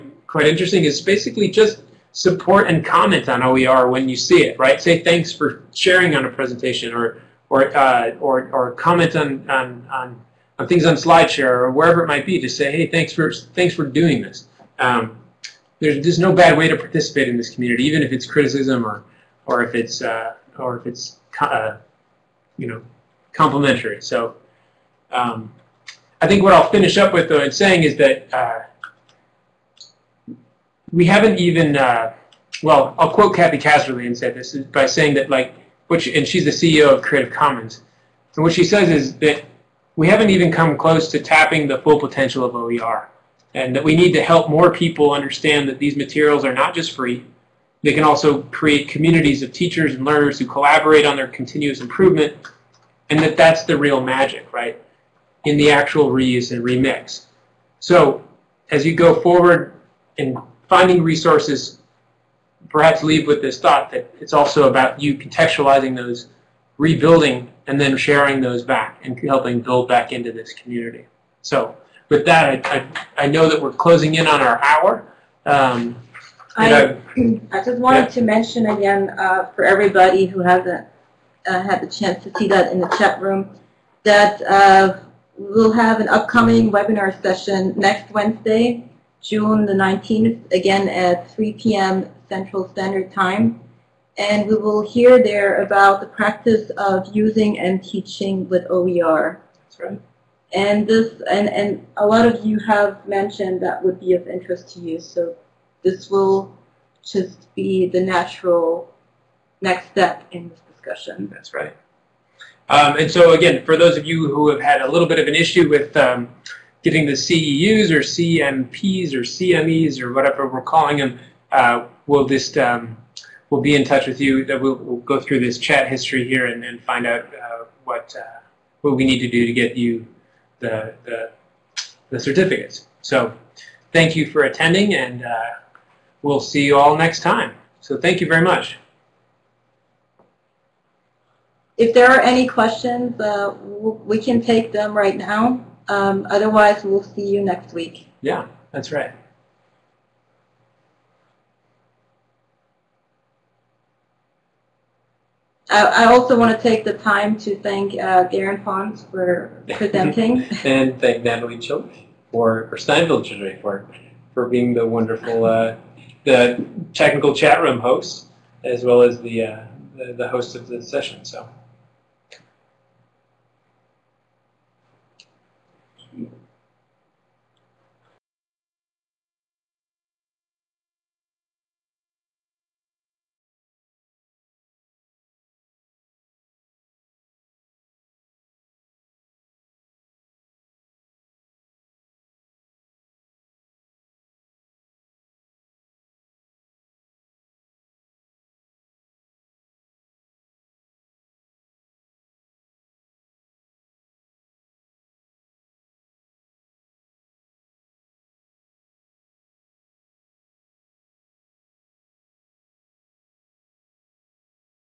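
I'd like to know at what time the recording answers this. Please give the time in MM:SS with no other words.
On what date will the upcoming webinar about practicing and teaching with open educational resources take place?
01:29.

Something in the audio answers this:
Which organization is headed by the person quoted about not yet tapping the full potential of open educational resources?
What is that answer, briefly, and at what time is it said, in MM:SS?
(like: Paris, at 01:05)
Creative Commons, at 00:37.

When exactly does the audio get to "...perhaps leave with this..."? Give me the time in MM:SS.
01:02.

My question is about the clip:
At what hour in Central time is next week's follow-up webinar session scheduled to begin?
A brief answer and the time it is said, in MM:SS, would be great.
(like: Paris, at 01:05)
3 p.m., at 01:31.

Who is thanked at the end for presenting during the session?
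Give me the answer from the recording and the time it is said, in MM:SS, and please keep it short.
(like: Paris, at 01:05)
Garen Pons, at 02:38.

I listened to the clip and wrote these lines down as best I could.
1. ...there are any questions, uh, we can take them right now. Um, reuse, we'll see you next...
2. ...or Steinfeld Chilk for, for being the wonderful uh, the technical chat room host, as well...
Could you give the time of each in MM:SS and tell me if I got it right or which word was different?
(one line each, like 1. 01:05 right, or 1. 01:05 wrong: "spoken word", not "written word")
1. 02:21 wrong: "otherwise", not "reuse"
2. 02:42 right.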